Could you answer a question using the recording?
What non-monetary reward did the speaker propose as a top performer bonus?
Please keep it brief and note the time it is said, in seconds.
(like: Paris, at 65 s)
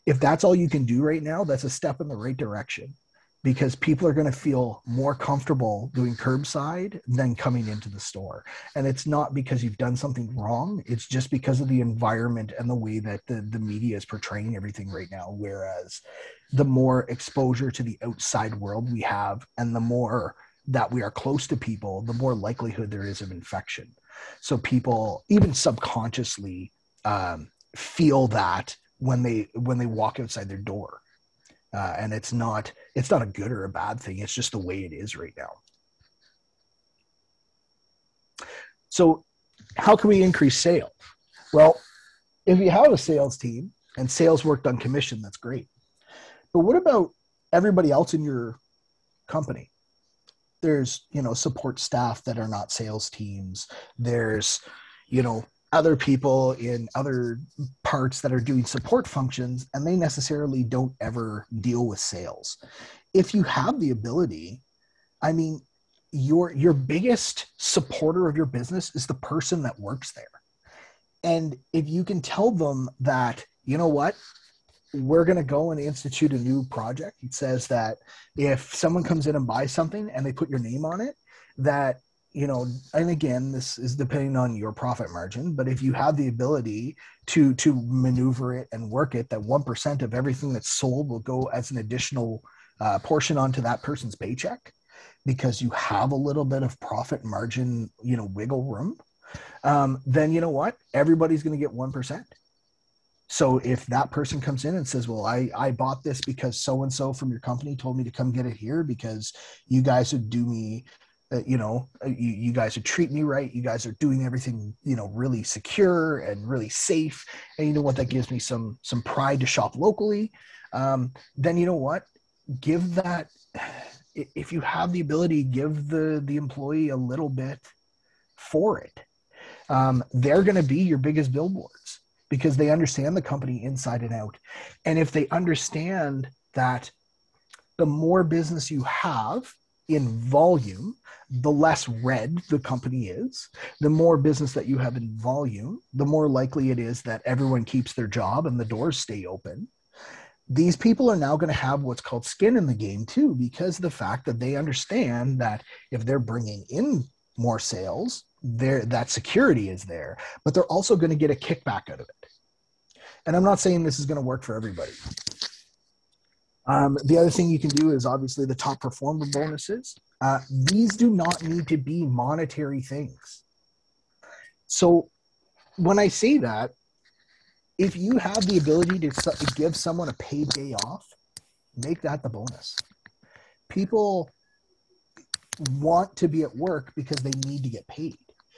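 paid day off, at 180 s.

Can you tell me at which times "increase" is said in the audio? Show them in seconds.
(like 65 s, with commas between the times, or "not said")
40 s.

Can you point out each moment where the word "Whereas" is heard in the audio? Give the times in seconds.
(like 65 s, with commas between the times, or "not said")
15 s.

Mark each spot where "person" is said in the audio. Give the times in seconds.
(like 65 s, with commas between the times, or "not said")
69 s, 93 s, 104 s.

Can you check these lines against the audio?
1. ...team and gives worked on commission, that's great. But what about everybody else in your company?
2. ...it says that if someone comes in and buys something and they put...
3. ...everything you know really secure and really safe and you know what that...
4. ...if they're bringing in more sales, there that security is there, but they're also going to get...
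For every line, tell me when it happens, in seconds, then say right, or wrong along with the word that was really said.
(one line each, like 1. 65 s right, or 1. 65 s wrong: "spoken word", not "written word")
1. 43 s wrong: "sales", not "gives"
2. 77 s right
3. 114 s right
4. 155 s right.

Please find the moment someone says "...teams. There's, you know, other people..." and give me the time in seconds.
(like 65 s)
53 s.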